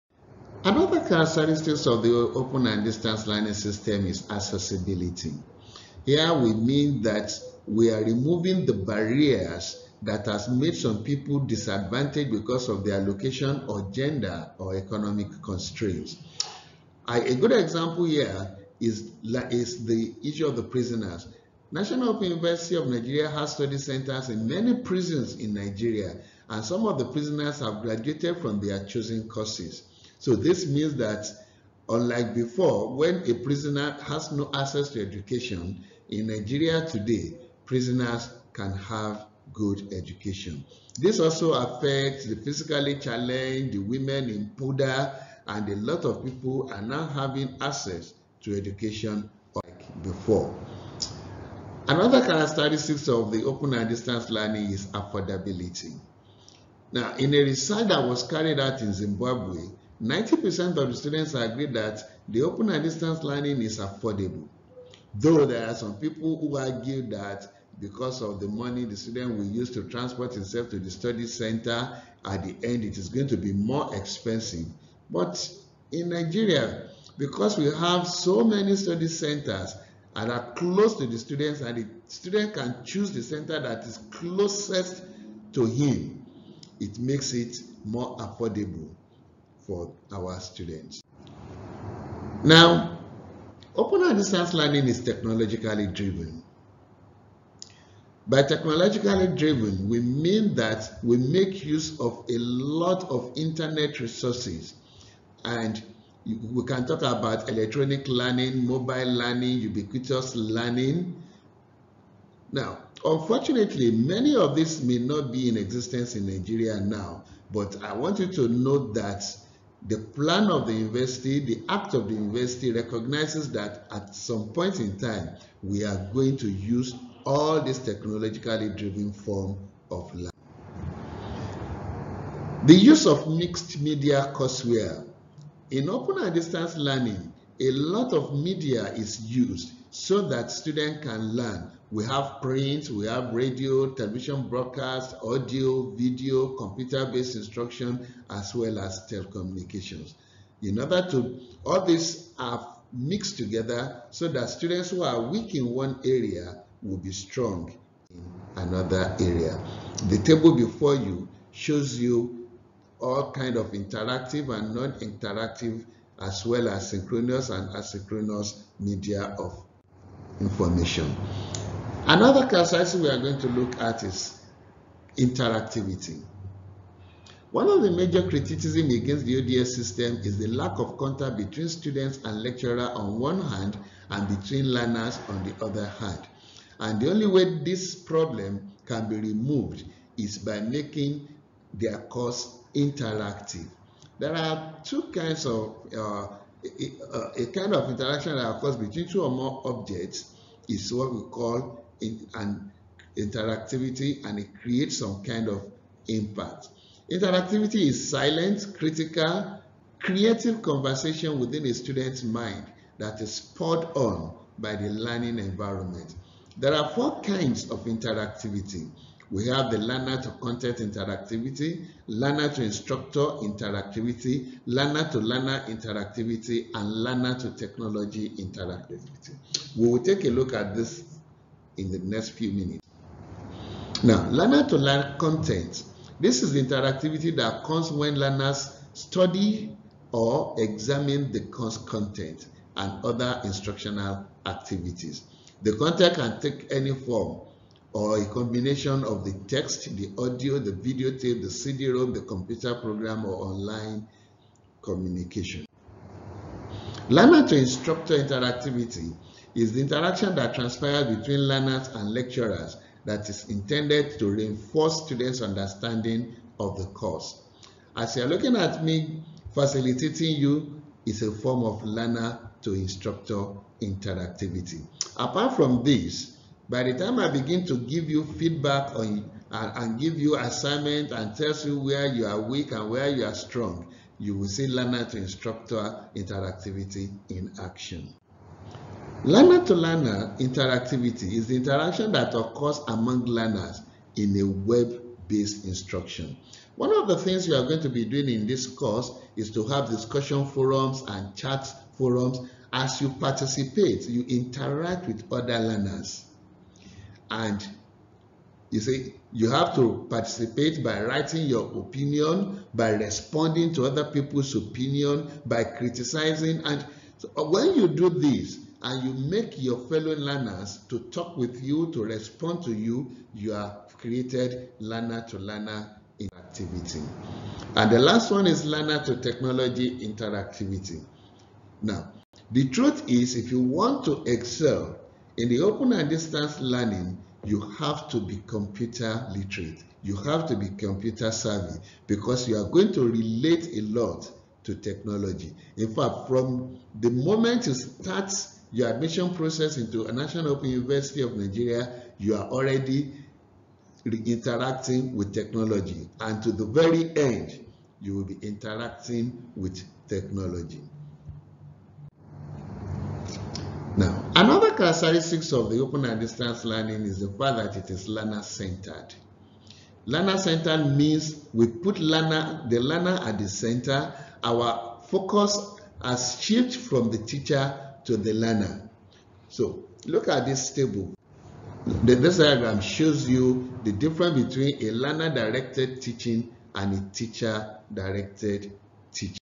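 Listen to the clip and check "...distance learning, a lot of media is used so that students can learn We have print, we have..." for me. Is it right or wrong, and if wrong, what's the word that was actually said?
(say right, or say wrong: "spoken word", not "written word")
right.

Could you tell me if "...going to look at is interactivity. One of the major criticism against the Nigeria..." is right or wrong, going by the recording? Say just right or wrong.
wrong.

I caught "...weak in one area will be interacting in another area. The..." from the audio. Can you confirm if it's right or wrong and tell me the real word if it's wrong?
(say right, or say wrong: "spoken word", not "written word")
wrong: "strong", not "interacting".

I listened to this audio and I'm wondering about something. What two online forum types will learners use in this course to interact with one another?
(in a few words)
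Discussion forums and chat forums.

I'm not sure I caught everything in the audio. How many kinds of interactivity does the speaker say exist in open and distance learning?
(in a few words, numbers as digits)
4.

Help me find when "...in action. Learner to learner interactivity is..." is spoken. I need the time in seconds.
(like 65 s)
287 s.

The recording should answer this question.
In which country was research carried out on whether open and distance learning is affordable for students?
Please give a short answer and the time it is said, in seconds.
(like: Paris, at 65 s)
Zimbabwe, at 58 s.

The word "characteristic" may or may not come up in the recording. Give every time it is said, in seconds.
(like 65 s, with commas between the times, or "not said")
0 s, 52 s, 364 s.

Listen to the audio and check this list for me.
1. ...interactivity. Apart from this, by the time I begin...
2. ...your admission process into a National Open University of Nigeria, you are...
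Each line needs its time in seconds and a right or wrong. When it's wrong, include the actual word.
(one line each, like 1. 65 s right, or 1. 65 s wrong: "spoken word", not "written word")
1. 273 s right
2. 348 s right.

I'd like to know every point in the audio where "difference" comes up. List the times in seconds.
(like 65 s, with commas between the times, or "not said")
383 s.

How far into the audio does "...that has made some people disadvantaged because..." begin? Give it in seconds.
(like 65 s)
10 s.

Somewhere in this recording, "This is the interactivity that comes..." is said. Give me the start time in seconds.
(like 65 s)
236 s.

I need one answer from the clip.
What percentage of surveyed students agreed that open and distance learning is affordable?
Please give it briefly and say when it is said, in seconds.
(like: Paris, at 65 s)
90%, at 60 s.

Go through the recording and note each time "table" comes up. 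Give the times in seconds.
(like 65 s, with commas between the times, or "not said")
160 s, 380 s.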